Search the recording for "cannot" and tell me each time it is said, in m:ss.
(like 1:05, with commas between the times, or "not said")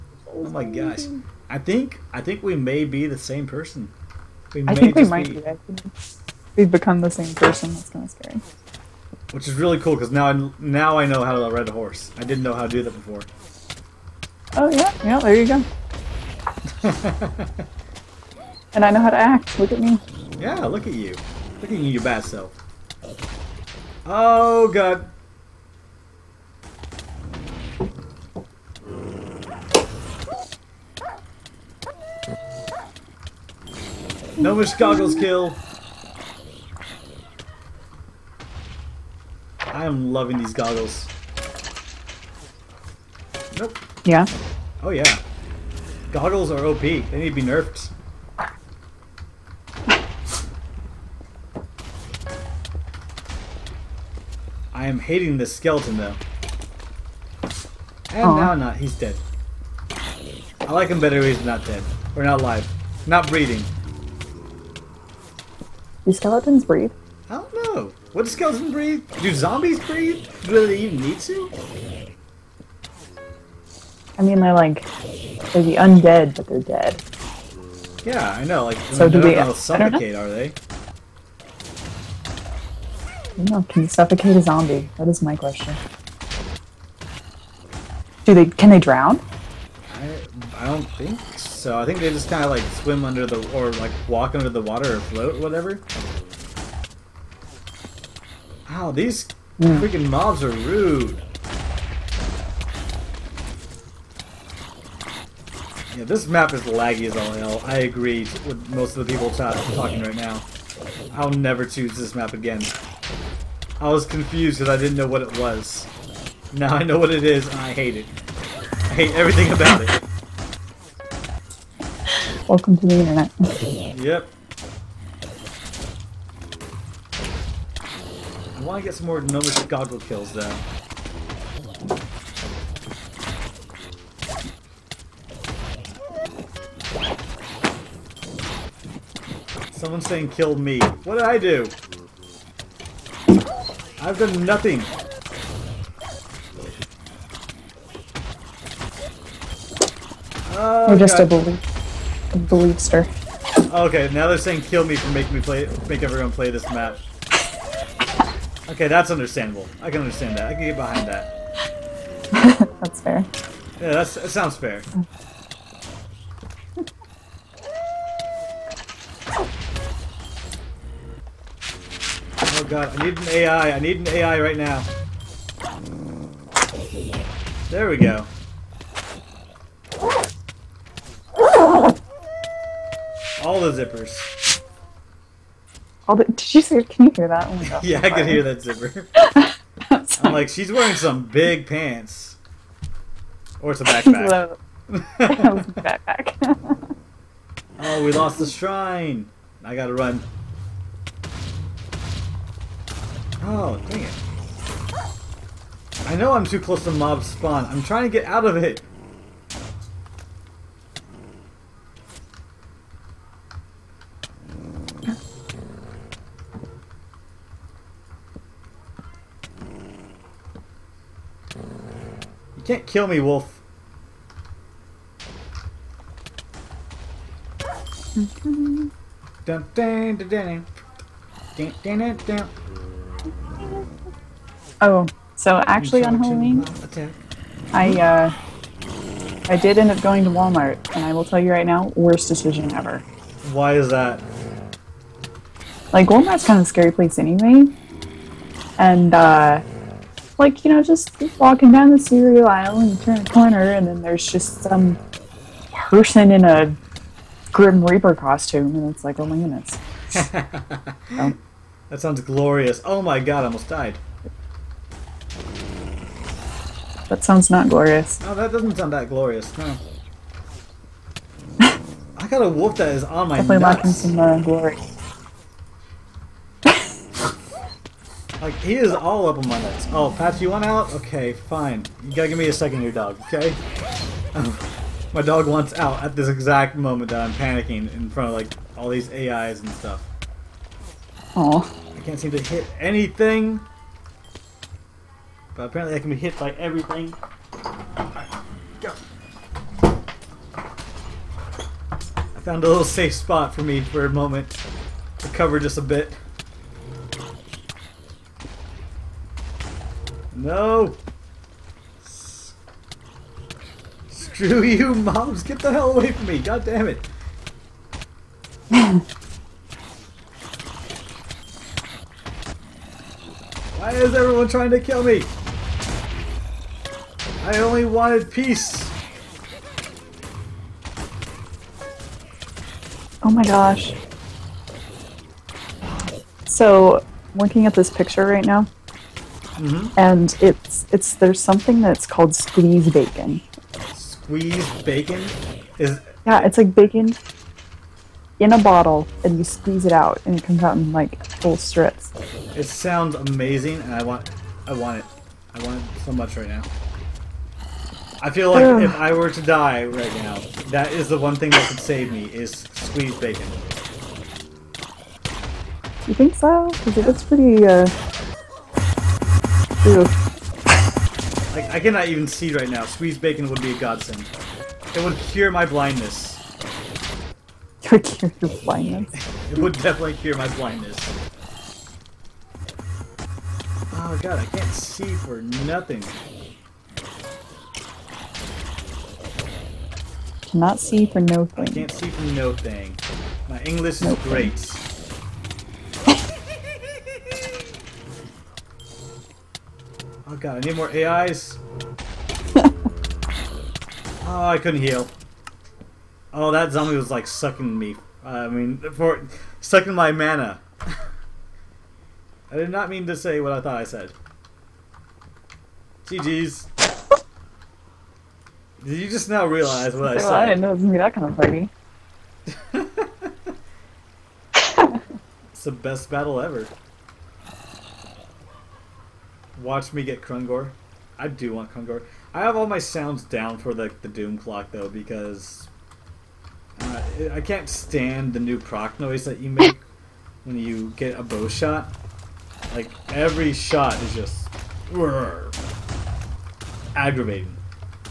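6:11, 6:30.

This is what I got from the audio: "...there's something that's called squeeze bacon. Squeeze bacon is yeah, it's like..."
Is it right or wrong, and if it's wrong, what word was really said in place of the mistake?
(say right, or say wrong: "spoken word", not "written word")
right.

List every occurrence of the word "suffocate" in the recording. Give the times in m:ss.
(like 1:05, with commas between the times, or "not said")
1:19, 1:23.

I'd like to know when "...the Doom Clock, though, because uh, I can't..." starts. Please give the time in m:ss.
7:14.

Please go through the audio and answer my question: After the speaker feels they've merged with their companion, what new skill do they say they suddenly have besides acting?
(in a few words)
ride a horse.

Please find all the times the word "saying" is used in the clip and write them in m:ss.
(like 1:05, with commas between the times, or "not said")
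2:20, 2:34.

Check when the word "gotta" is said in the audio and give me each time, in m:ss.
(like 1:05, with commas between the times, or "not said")
3:19, 4:42.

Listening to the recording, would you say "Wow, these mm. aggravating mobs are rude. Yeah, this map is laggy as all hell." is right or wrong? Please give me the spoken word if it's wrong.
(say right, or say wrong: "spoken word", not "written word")
wrong: "freaking", not "aggravating".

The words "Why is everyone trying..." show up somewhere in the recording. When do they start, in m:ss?
5:23.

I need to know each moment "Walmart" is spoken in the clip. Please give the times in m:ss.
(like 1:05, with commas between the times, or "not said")
4:00, 4:06.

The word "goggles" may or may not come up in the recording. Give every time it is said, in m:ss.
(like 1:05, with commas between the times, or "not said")
0:34, 0:40, 0:46, 2:09.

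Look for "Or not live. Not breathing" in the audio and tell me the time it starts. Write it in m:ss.
1:02.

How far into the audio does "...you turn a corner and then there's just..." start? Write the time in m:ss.
4:12.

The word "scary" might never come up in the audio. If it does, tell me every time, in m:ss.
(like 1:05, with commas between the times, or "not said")
0:08, 4:06.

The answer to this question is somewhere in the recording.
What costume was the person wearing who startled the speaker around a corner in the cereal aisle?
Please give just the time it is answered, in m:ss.
4:17.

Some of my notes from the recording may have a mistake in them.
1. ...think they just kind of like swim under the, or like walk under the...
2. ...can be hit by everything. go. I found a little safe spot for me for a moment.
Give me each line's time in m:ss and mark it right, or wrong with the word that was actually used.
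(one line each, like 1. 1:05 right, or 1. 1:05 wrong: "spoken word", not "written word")
1. 1:31 right
2. 4:56 right.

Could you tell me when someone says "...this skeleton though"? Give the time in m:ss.
0:55.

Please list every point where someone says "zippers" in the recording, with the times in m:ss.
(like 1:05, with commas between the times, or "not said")
3:03, 3:08.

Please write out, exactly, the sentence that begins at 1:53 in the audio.
I was confused because I didn't know what it was.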